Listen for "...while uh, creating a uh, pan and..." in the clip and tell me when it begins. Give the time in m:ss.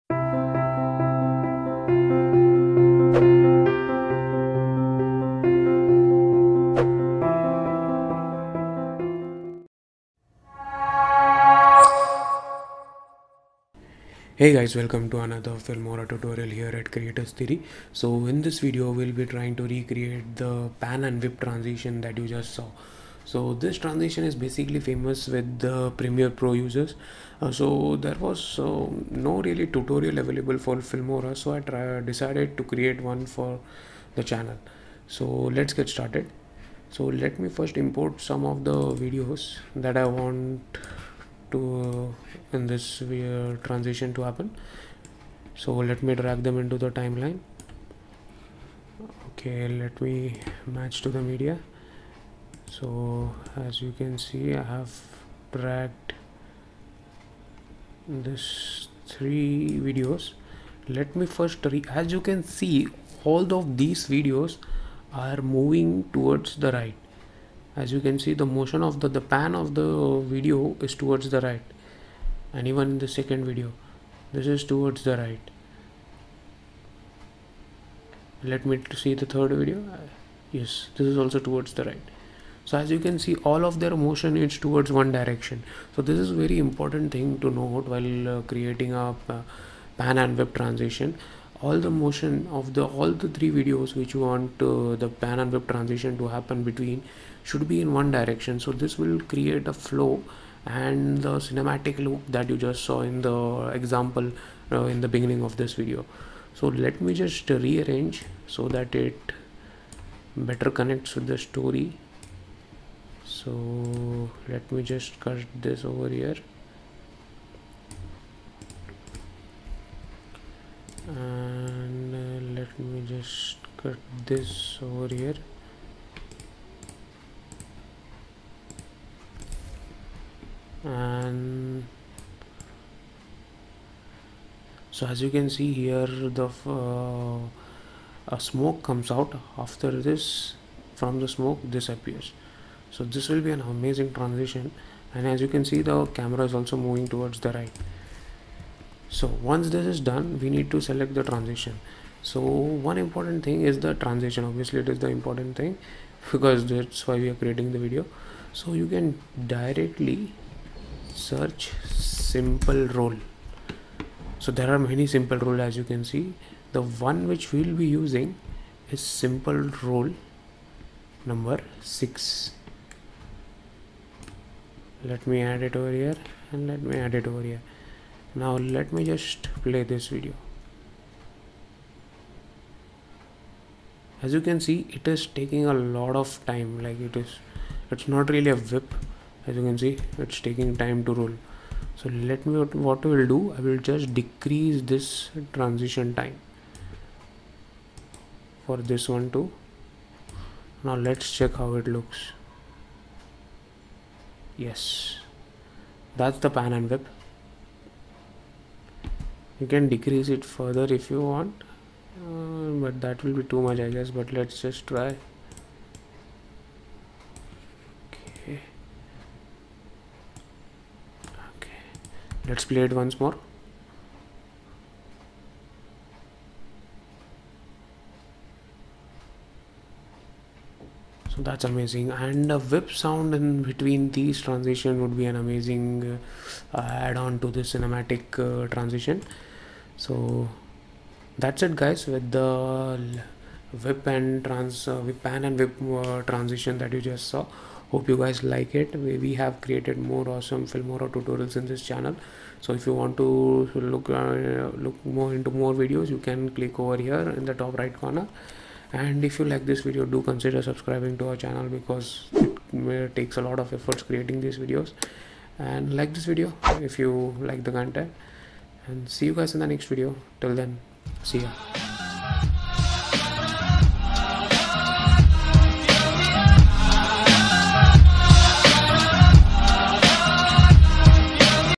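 1:27.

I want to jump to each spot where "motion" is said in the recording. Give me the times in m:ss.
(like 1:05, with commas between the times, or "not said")
1:08, 1:23, 1:31.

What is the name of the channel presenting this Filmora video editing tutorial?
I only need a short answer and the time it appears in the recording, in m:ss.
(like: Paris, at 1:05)
Creators Theory, at 0:16.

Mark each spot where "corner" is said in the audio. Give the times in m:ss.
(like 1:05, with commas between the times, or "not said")
4:17.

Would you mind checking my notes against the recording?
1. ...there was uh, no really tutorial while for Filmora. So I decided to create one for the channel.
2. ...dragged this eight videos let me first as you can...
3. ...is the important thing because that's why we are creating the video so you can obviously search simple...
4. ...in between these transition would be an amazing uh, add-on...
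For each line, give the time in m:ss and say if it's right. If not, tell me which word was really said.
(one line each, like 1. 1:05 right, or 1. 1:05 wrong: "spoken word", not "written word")
1. 0:27 wrong: "available", not "while"
2. 0:55 wrong: "three", not "eight"
3. 2:34 wrong: "directly", not "obviously"
4. 3:53 right.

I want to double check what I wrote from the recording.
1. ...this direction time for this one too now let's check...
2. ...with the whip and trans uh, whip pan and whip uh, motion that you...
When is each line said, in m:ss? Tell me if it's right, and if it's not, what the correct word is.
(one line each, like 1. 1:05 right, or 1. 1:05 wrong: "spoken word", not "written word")
1. 3:14 wrong: "transition", not "direction"
2. 4:02 wrong: "transition", not "motion".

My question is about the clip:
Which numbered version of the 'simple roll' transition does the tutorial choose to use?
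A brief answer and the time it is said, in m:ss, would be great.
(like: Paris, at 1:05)
6, at 2:51.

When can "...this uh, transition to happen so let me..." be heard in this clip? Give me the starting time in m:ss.
0:42.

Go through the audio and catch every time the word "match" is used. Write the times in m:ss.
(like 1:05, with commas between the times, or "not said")
0:50.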